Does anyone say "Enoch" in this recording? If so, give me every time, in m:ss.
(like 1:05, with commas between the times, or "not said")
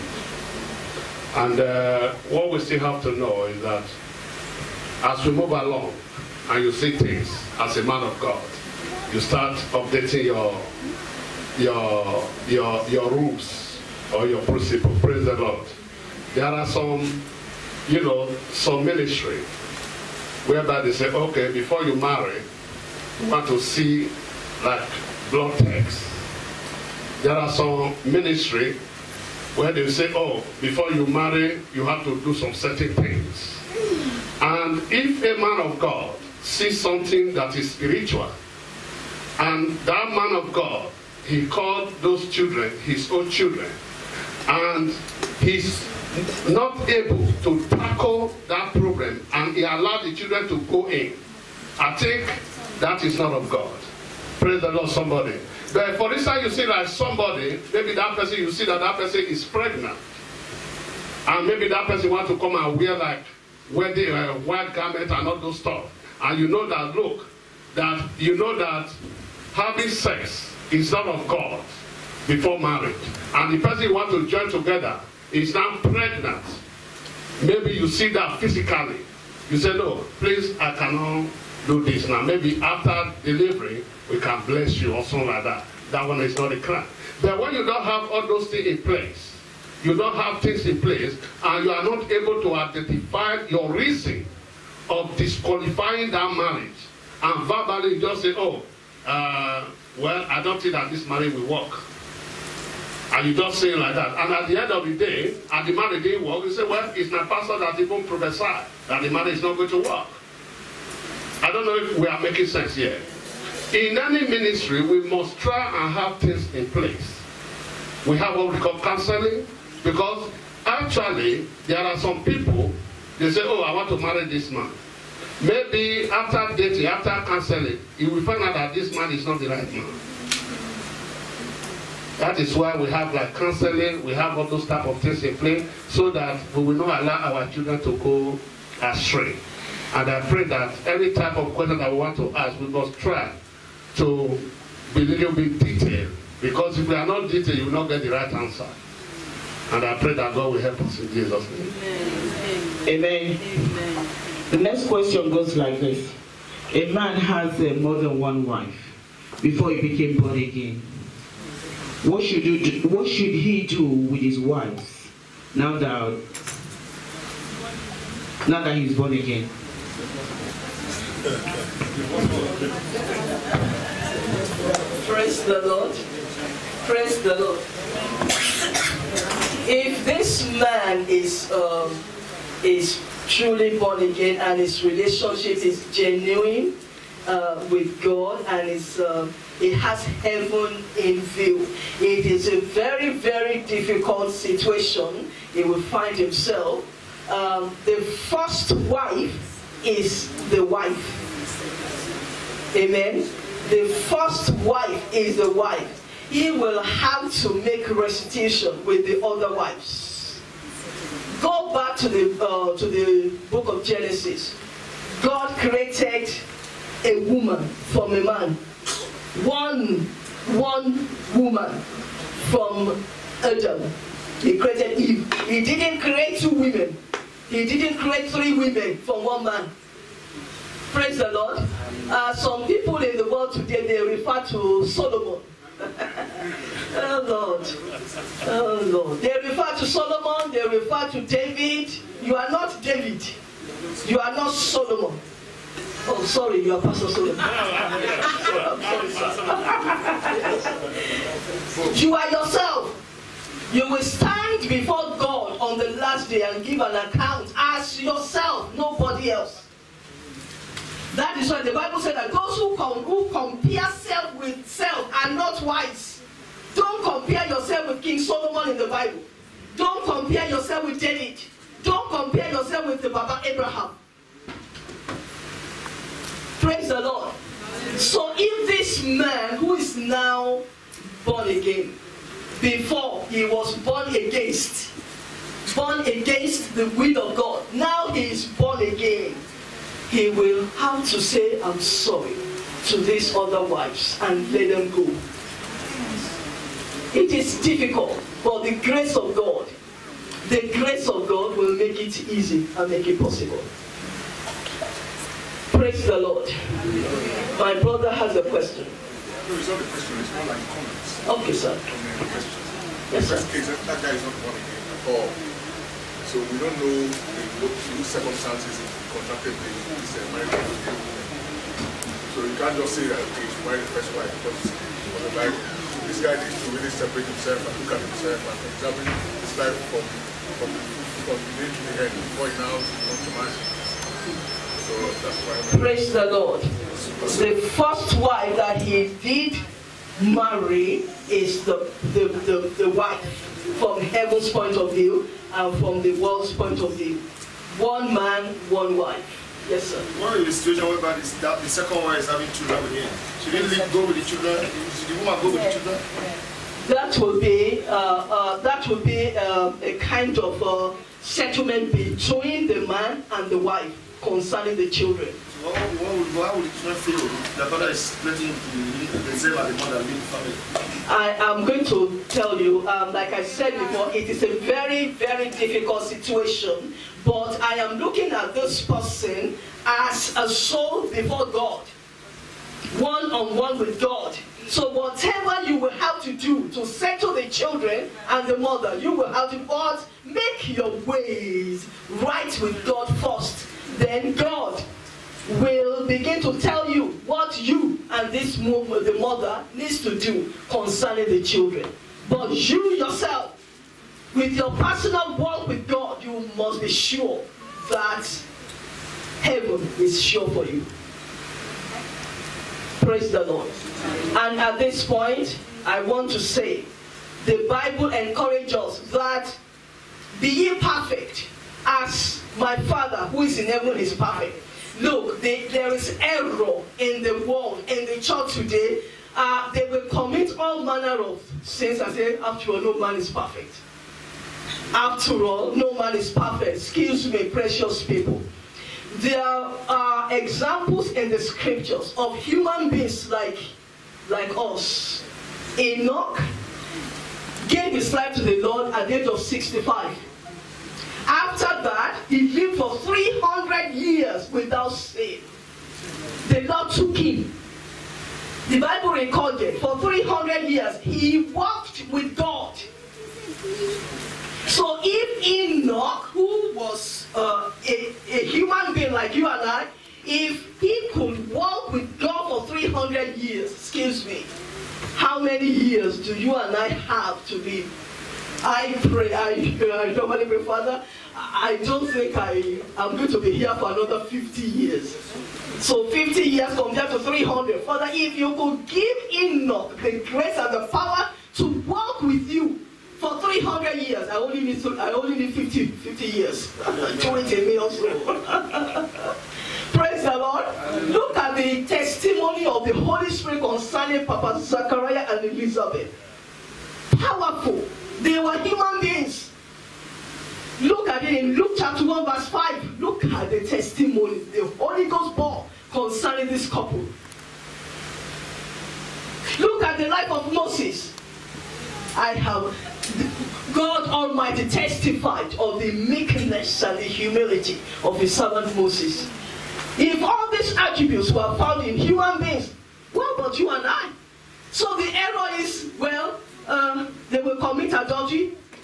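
7:25, 7:45.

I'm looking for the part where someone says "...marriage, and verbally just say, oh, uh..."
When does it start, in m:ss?
1:36.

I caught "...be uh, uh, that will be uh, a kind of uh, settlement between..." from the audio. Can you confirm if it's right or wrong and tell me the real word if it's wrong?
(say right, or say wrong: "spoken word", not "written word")
right.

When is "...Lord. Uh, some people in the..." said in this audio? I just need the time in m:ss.
3:51.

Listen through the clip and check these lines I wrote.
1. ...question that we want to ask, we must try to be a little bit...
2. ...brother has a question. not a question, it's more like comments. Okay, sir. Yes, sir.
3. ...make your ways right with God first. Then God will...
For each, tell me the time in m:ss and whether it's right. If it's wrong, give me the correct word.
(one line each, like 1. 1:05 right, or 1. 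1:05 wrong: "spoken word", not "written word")
1. 2:21 right
2. 5:07 right
3. 6:30 right.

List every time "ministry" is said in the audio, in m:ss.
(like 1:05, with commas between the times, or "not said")
0:18, 0:28, 1:54.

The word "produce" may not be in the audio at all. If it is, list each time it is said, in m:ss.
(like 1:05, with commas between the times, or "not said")
not said.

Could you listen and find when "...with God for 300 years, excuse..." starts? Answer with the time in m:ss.
7:51.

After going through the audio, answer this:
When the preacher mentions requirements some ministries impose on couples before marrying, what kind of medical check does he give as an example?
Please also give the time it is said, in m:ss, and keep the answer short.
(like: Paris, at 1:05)
Blood tests, at 0:25.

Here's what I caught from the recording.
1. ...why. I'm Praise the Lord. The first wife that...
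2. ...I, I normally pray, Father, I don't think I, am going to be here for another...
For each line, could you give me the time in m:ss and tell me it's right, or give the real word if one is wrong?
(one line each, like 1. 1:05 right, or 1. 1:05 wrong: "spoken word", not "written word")
1. 5:35 right
2. 7:59 right.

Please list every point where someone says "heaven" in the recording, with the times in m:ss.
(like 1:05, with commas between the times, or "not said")
3:10, 5:44, 6:49, 7:03.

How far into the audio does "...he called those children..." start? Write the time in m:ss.
0:41.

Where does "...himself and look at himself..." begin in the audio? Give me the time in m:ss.
5:27.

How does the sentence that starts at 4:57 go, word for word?
It is difficult, but the grace of God, the grace of God will make it easy and make it possible.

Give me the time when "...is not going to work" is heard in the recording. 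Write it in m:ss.
1:49.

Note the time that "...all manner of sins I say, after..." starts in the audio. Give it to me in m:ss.
7:10.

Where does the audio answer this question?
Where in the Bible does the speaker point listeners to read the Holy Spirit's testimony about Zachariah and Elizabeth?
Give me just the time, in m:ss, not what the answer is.
8:31.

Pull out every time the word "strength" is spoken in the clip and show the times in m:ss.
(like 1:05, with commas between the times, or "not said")
not said.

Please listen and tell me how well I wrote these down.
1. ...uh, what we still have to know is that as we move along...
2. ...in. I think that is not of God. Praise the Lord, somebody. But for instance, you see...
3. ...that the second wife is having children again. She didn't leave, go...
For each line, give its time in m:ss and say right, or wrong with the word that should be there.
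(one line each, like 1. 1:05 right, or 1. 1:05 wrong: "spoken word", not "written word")
1. 0:01 right
2. 0:50 right
3. 5:51 right.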